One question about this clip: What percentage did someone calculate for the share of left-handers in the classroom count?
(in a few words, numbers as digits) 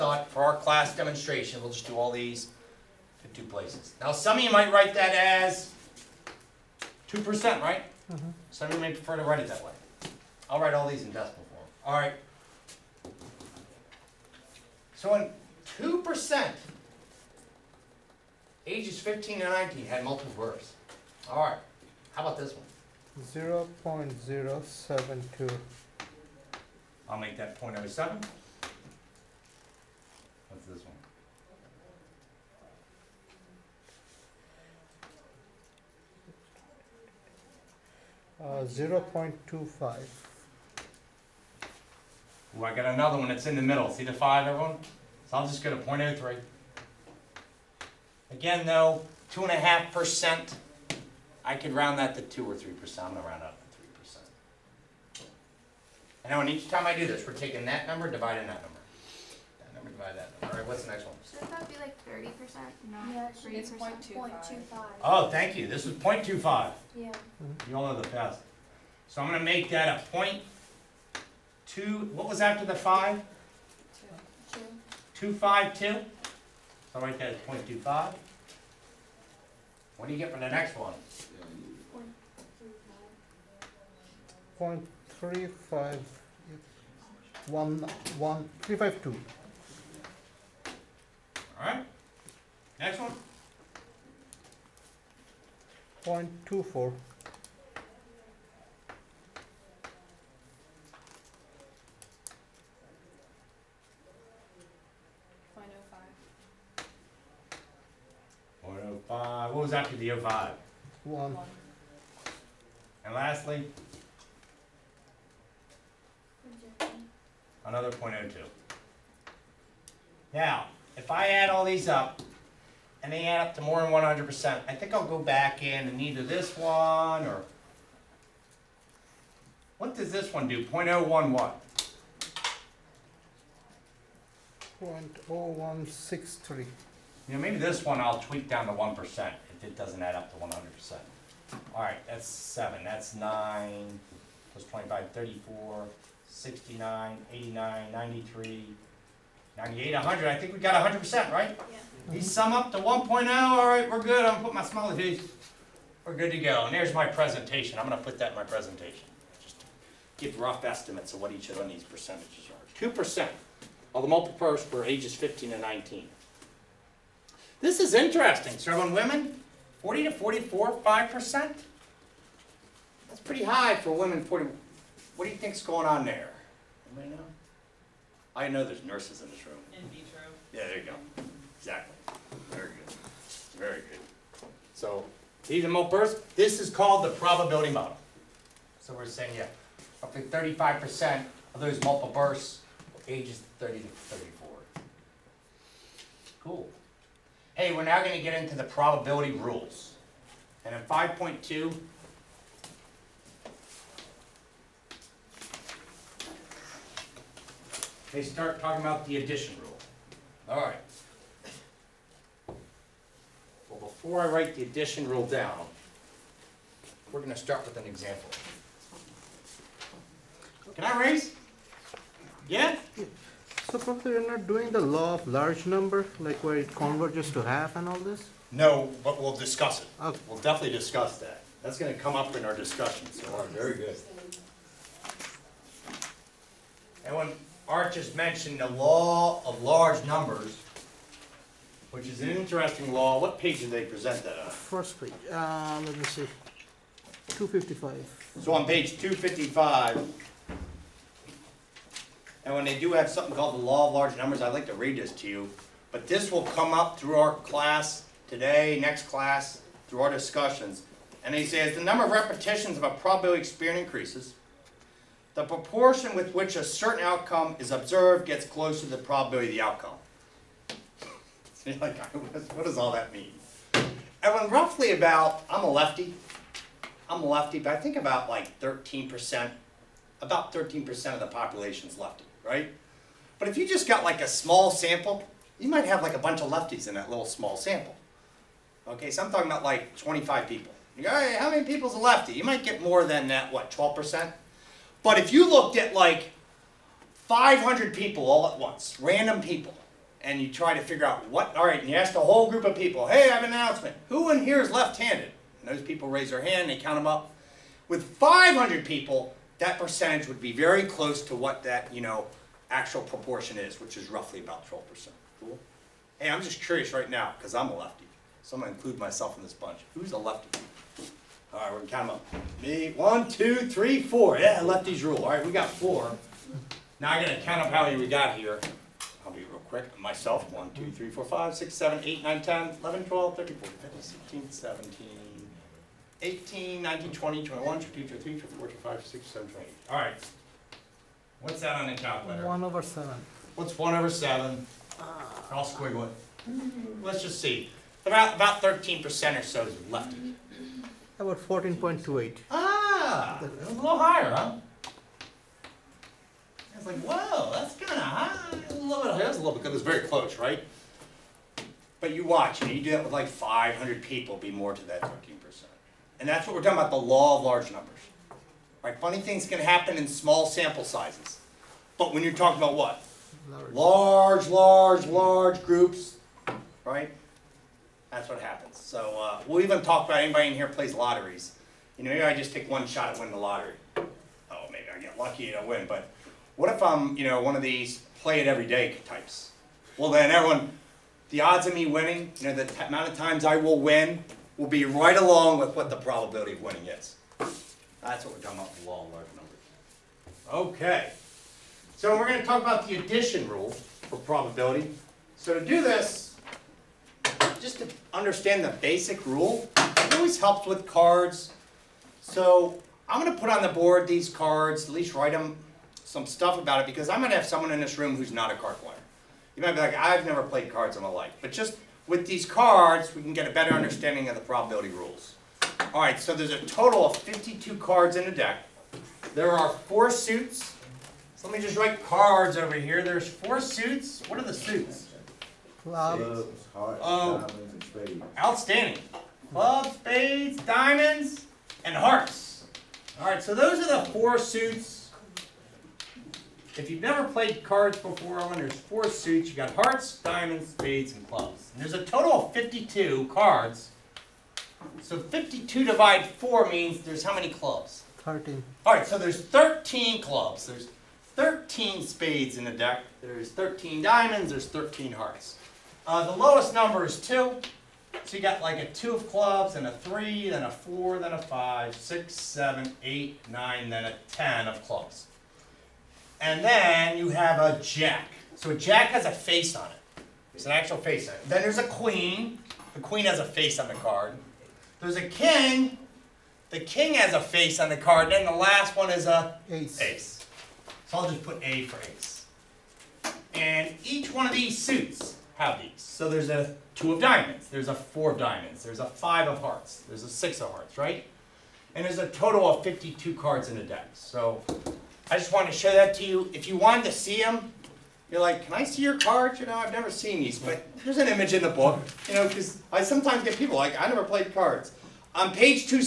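14.28%.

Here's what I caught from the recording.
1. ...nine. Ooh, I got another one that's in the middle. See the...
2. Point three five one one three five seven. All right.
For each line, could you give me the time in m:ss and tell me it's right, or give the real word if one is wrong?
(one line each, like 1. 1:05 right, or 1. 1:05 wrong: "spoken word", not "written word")
1. 0:39 wrong: "five", not "nine"
2. 1:24 wrong: "two", not "seven".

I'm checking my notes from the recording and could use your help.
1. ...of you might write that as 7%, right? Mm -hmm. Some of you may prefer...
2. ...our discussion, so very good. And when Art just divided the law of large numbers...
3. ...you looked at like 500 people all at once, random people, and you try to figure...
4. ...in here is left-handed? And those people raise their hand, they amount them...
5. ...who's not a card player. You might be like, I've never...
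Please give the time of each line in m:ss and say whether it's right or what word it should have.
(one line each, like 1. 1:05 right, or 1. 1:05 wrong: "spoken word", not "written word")
1. 0:04 wrong: "2", not "7"
2. 3:52 wrong: "mentioned", not "divided"
3. 4:55 right
4. 5:04 wrong: "count", not "amount"
5. 6:58 right.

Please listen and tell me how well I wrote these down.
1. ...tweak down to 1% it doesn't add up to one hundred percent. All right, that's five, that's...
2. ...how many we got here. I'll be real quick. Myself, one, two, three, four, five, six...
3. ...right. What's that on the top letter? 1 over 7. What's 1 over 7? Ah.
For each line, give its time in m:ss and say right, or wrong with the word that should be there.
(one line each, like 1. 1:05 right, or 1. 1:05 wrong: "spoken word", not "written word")
1. 2:18 wrong: "seven", not "five"
2. 5:27 right
3. 5:39 right.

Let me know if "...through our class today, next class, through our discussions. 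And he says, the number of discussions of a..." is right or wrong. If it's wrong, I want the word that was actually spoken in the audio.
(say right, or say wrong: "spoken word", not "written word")
wrong: "repetitions", not "discussions".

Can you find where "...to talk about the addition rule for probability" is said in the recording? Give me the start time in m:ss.
6:42.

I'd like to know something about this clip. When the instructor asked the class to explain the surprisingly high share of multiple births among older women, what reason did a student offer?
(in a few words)
In vitro.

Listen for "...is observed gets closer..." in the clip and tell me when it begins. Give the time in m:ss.
4:27.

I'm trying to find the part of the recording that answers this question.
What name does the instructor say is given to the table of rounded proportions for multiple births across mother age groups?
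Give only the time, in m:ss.
3:07.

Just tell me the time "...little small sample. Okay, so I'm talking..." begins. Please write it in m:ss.
4:47.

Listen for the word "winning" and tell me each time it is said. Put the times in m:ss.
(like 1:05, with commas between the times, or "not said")
6:23, 6:31, 6:36.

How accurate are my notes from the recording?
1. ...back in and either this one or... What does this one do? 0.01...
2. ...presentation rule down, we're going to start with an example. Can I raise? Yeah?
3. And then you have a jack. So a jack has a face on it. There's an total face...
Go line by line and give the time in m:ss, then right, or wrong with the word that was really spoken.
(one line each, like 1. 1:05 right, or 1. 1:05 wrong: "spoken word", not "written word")
1. 2:05 right
2. 3:34 wrong: "addition", not "presentation"
3. 7:56 wrong: "actual", not "total".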